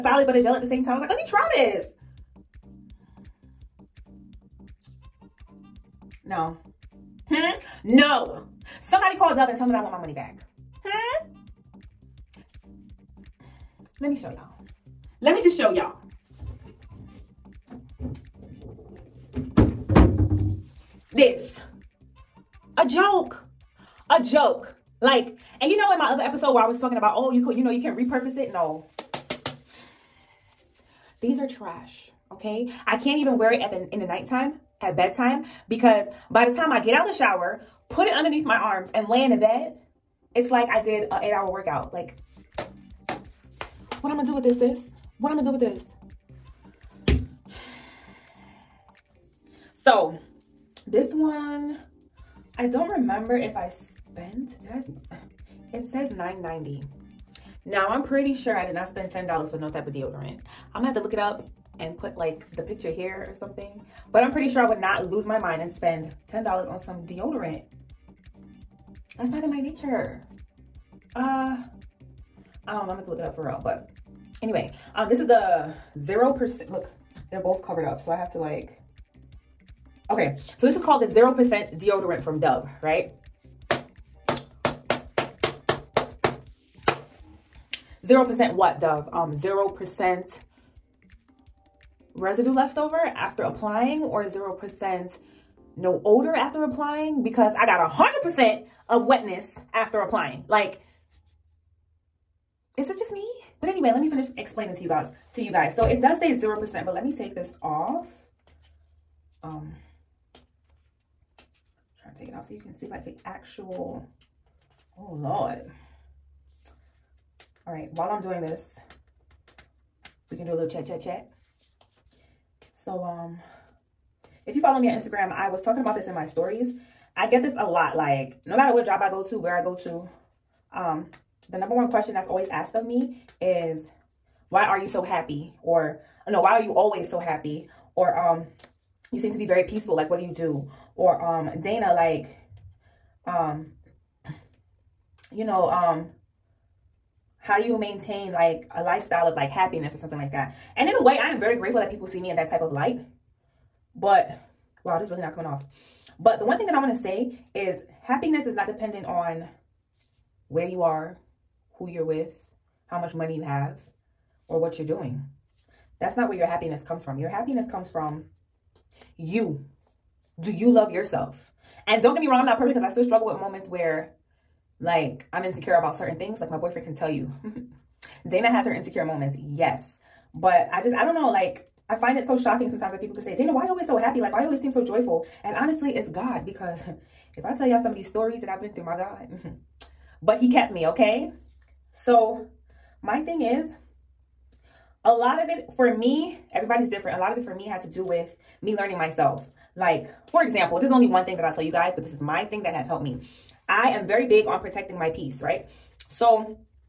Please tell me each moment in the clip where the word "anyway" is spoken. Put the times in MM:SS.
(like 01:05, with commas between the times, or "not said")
01:14, 01:43.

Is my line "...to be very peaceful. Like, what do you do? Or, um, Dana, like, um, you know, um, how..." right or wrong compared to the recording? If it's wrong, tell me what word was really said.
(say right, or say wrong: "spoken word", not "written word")
right.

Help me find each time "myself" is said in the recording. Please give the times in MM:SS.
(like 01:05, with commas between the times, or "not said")
03:18.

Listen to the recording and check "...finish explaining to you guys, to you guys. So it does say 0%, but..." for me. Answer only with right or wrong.
right.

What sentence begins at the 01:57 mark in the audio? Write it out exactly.
All right, while I'm doing this, we can do a little chat, chat, chat.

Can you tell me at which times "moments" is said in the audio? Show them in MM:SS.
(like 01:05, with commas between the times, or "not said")
02:53, 02:59.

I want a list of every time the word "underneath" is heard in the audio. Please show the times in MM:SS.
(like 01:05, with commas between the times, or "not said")
00:38.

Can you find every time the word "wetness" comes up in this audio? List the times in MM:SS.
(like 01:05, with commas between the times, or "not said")
01:39.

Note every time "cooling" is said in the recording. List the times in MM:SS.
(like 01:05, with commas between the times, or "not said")
not said.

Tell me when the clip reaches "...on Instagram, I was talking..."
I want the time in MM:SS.
02:04.